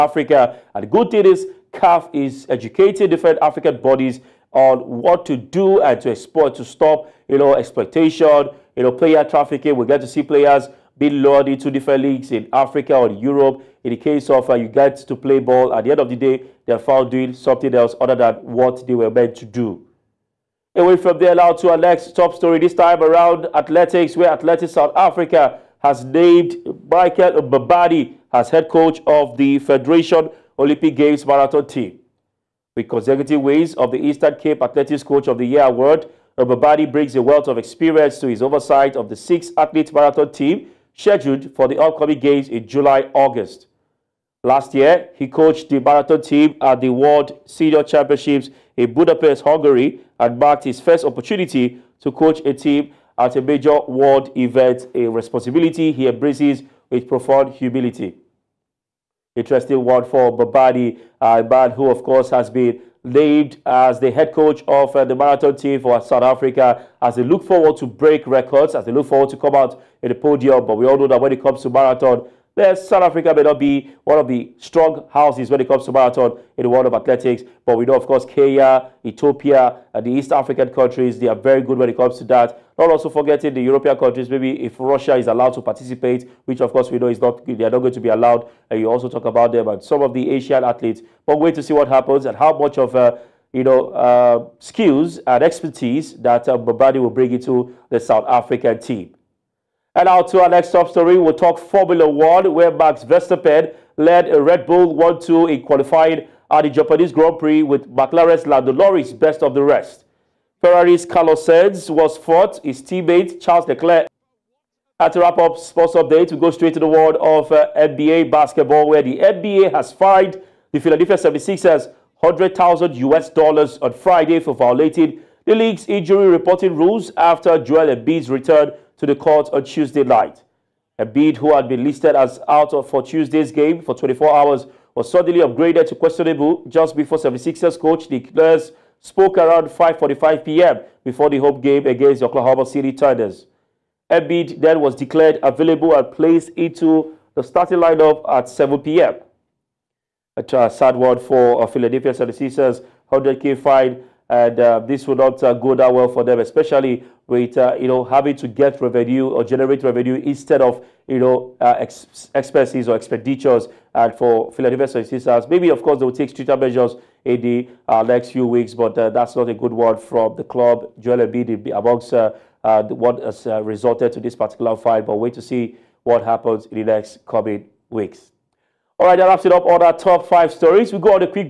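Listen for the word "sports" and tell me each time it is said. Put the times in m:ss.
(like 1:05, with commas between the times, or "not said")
1:55.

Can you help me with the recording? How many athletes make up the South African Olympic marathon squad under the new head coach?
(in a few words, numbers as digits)
6.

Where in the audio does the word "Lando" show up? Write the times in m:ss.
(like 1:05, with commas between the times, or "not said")
1:48.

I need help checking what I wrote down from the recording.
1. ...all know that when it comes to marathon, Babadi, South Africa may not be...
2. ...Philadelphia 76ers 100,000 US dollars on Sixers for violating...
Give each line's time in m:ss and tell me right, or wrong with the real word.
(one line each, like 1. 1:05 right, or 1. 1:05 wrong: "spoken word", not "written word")
1. 1:10 wrong: "Yes", not "Babadi"
2. 2:00 wrong: "Friday", not "Sixers".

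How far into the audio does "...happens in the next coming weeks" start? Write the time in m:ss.
2:56.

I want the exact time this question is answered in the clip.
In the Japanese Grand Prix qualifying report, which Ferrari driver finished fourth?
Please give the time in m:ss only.
1:51.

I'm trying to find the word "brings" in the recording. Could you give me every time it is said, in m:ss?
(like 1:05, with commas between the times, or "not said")
0:36, 1:37.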